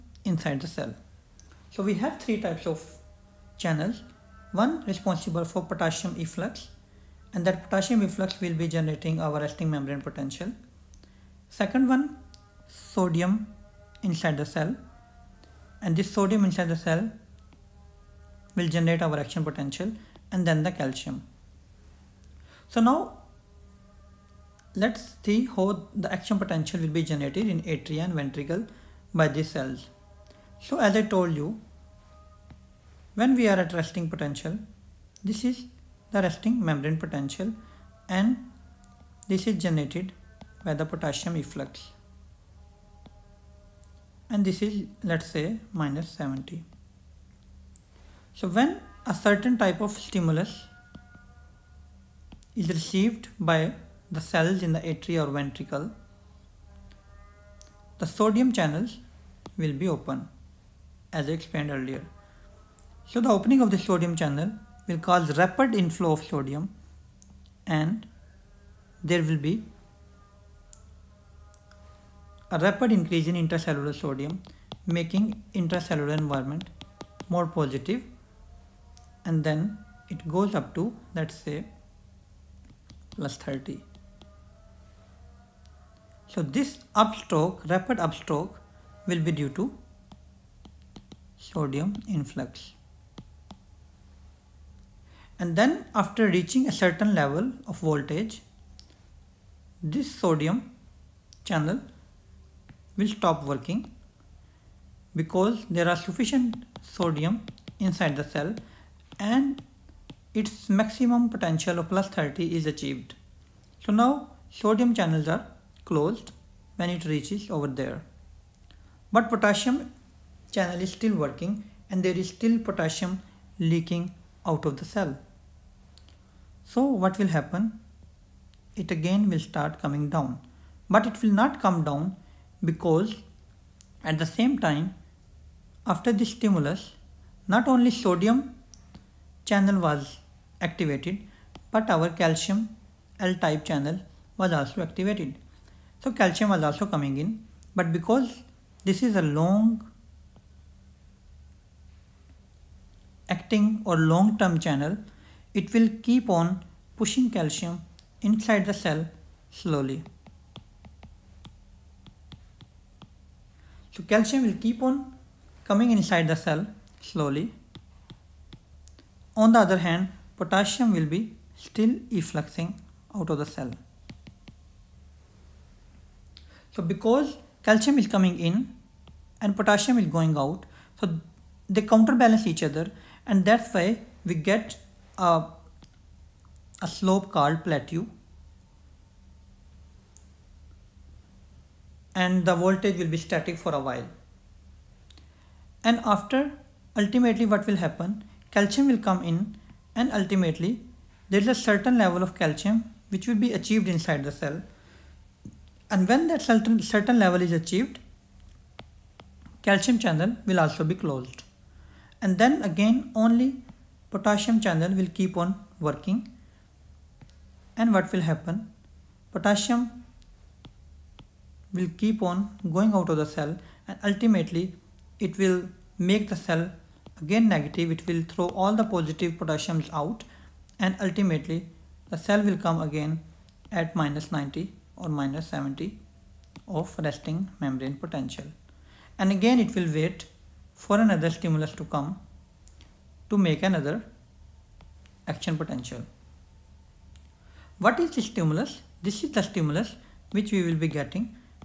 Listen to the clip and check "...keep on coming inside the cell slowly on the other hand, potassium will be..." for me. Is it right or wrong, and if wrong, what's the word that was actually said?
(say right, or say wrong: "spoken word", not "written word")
right.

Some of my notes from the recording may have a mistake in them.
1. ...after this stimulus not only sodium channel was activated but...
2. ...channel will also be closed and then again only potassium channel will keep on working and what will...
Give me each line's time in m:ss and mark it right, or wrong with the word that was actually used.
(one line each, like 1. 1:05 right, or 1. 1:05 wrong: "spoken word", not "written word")
1. 2:15 right
2. 3:29 right.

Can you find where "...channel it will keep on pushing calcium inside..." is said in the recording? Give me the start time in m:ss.
2:34.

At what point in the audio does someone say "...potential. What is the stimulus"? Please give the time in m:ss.
4:05.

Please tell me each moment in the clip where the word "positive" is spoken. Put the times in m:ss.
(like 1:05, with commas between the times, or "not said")
1:17, 3:48.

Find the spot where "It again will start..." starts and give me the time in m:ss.
2:08.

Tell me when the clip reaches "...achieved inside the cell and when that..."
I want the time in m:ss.
3:23.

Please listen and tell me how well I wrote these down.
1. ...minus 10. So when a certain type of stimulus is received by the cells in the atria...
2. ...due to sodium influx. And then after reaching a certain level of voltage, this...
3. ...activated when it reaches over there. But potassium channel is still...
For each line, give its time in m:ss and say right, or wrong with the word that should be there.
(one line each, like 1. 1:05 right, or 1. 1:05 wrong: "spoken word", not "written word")
1. 0:45 wrong: "70", not "10"
2. 1:29 right
3. 1:55 wrong: "closed", not "activated".